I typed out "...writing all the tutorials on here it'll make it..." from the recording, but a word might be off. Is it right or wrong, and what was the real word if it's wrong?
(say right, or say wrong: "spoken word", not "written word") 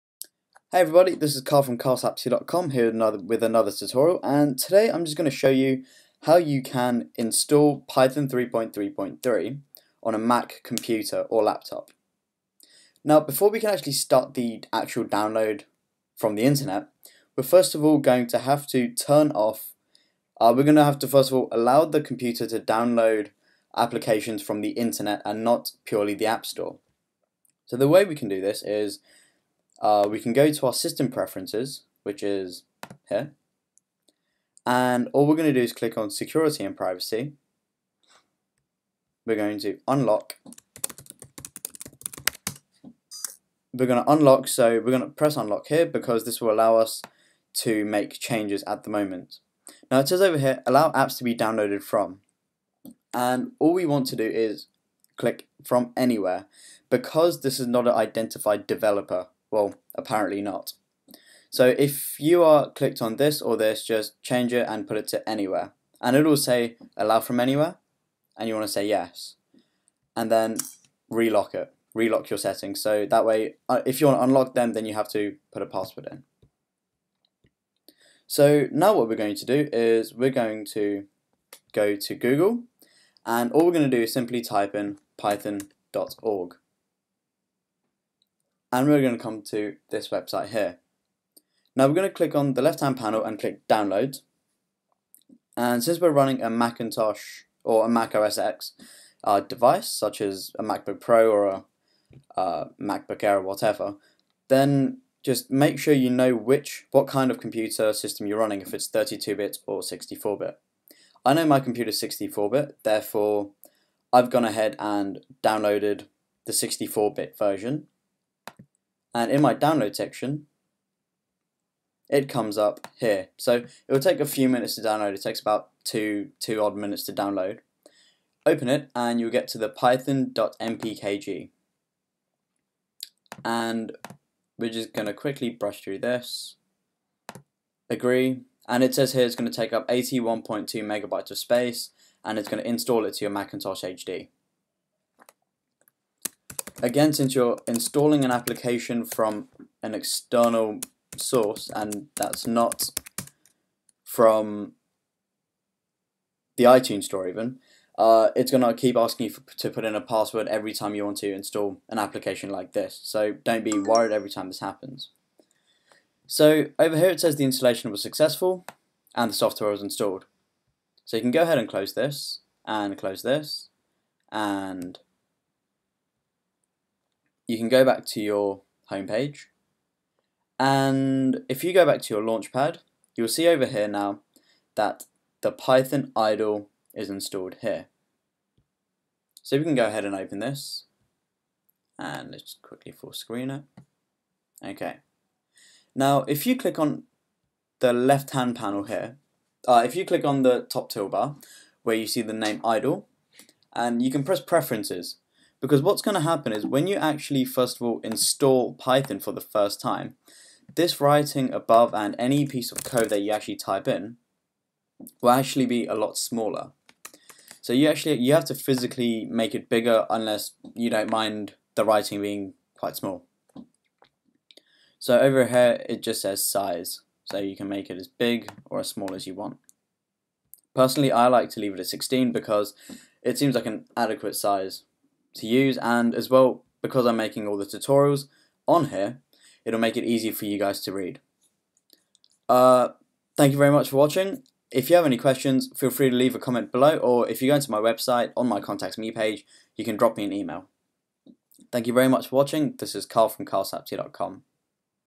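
wrong: "making", not "writing".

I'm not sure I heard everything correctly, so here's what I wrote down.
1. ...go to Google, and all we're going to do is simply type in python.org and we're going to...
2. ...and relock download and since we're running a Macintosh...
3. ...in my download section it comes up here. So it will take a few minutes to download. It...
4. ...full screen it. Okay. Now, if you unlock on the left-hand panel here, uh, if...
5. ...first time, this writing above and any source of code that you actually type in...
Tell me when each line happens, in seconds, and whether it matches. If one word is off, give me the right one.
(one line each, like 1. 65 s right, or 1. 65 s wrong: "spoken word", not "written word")
1. 81 s right
2. 93 s wrong: "click", not "relock"
3. 119 s right
4. 192 s wrong: "click", not "unlock"
5. 209 s wrong: "piece", not "source".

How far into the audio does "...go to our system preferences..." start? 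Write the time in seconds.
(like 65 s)
30 s.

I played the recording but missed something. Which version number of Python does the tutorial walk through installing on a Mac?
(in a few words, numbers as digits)
3.3.3.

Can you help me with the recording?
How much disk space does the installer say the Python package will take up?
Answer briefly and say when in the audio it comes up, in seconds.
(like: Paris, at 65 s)
81.2 megabytes, at 139 s.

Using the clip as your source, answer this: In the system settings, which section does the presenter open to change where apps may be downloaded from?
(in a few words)
Security and privacy.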